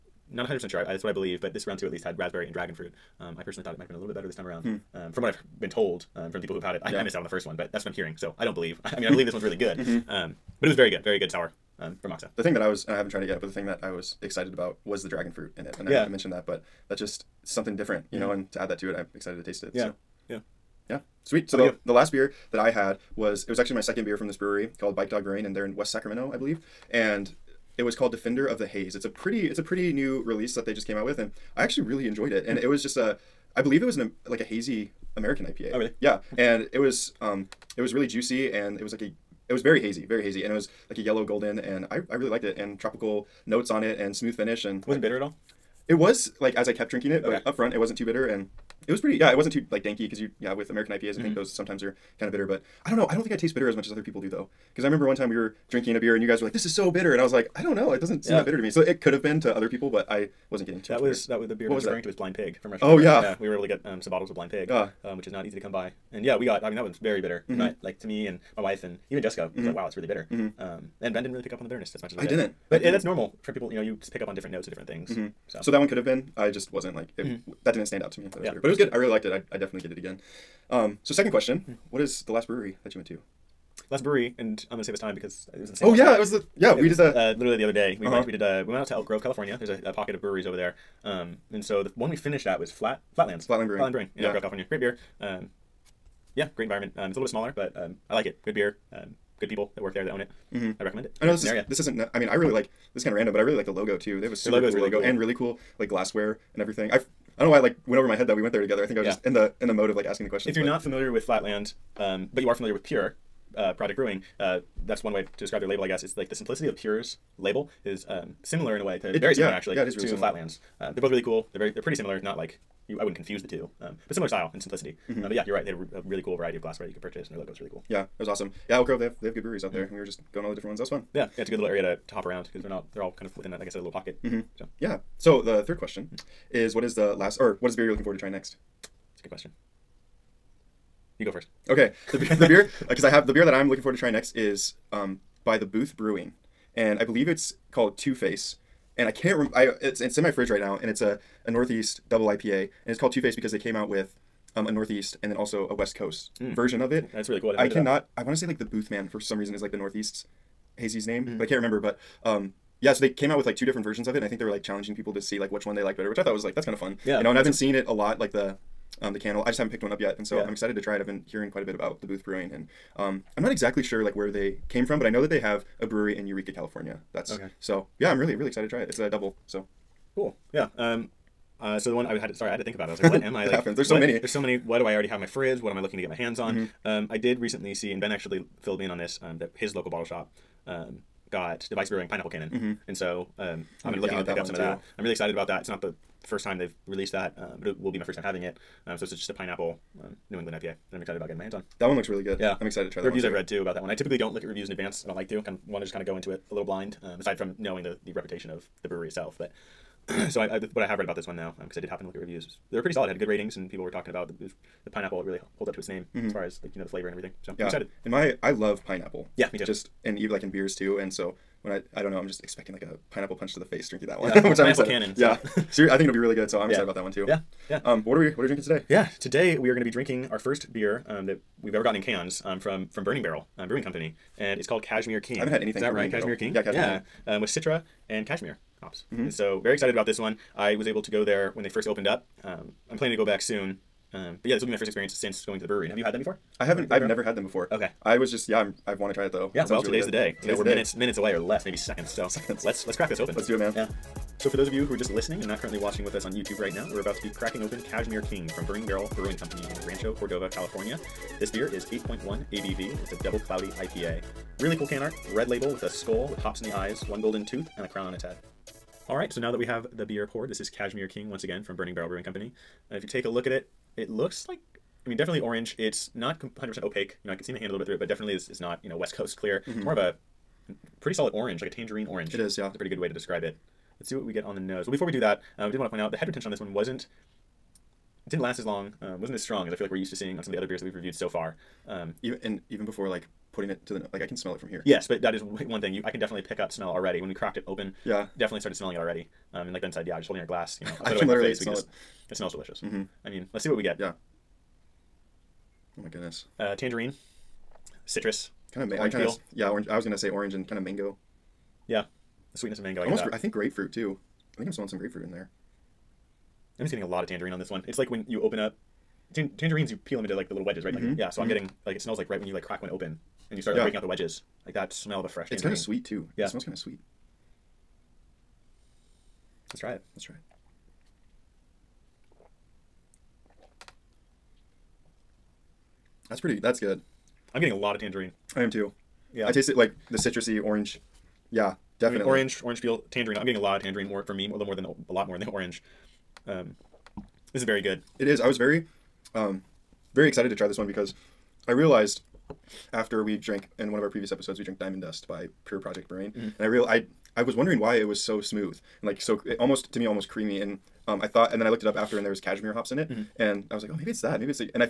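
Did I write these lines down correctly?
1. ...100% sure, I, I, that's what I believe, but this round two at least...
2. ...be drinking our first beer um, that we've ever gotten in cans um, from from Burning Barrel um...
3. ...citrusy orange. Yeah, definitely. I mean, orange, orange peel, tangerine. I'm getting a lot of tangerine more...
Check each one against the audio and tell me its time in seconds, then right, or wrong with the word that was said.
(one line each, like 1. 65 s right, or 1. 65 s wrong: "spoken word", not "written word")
1. 0 s right
2. 229 s right
3. 340 s right.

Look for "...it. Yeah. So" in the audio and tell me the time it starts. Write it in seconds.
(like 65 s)
19 s.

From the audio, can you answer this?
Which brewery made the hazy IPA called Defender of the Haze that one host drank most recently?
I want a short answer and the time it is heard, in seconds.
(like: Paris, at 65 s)
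Bike Dog Brewing, at 24 s.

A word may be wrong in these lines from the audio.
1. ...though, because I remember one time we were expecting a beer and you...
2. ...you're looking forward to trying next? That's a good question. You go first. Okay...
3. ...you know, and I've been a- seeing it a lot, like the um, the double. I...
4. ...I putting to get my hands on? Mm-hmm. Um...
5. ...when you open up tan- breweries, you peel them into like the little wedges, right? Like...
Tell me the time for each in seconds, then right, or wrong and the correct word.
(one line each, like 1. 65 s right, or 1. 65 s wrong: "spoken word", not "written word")
1. 54 s wrong: "drinking", not "expecting"
2. 137 s right
3. 167 s wrong: "candle", not "double"
4. 185 s wrong: "looking", not "putting"
5. 318 s wrong: "tangerines", not "breweries".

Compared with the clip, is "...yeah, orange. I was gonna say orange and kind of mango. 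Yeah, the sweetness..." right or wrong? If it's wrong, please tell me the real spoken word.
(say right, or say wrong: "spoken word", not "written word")
right.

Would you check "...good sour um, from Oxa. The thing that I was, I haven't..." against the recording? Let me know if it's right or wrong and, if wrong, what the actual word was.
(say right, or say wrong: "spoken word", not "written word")
right.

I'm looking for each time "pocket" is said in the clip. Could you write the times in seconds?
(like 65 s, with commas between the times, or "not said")
89 s, 133 s.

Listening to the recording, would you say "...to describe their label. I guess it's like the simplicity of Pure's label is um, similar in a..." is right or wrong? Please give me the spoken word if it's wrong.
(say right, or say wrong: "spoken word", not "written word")
right.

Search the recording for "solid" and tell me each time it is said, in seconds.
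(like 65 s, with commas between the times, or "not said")
212 s, 281 s.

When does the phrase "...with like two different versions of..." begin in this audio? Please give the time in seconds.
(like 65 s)
163 s.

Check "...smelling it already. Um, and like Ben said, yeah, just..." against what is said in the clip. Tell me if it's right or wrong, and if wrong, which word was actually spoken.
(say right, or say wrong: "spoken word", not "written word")
right.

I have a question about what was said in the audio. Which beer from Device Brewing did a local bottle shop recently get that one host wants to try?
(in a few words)
Pineapple Cannon.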